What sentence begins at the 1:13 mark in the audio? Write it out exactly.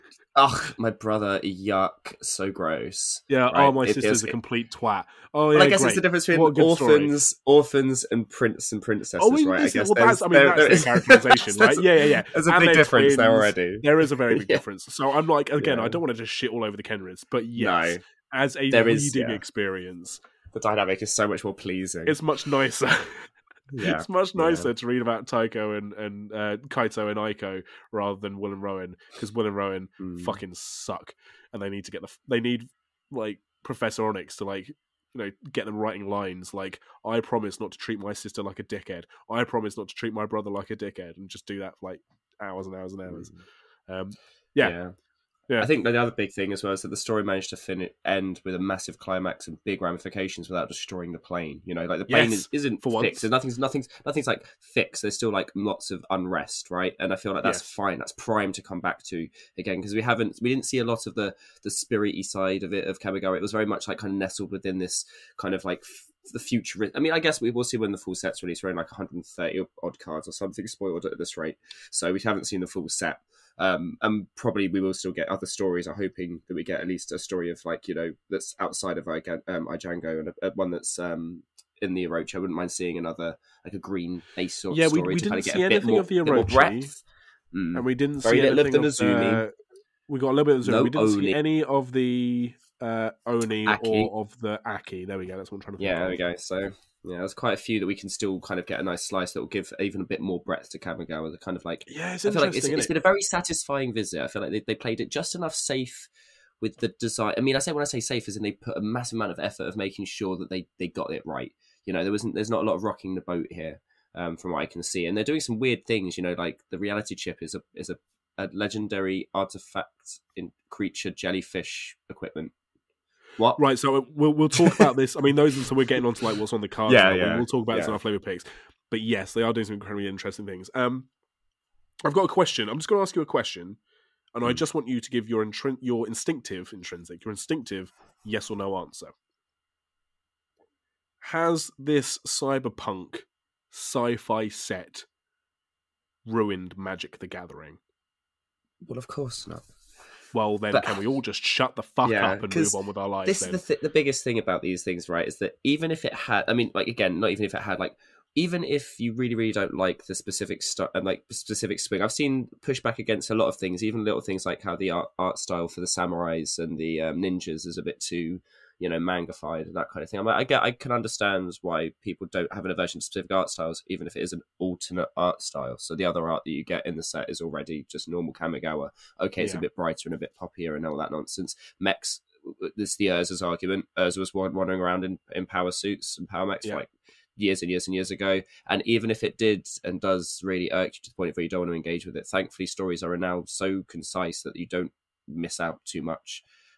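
Um, and probably we will still get other stories.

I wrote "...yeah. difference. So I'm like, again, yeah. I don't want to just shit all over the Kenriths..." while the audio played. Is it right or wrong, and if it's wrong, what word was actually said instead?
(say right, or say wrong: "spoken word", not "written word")
right.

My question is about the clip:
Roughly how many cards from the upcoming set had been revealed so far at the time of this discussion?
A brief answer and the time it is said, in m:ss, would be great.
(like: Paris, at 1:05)
130, at 1:08.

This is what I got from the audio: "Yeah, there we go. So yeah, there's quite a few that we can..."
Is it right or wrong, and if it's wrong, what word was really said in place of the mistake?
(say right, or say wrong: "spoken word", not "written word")
right.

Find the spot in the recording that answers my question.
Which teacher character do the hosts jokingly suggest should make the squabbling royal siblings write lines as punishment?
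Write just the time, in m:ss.
0:33.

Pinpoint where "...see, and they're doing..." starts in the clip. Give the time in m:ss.
1:54.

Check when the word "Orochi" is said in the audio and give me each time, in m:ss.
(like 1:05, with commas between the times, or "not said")
1:22, 1:26.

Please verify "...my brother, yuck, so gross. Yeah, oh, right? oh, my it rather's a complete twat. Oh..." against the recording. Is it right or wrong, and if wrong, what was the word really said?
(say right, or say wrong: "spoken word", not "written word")
wrong: "sister", not "rather".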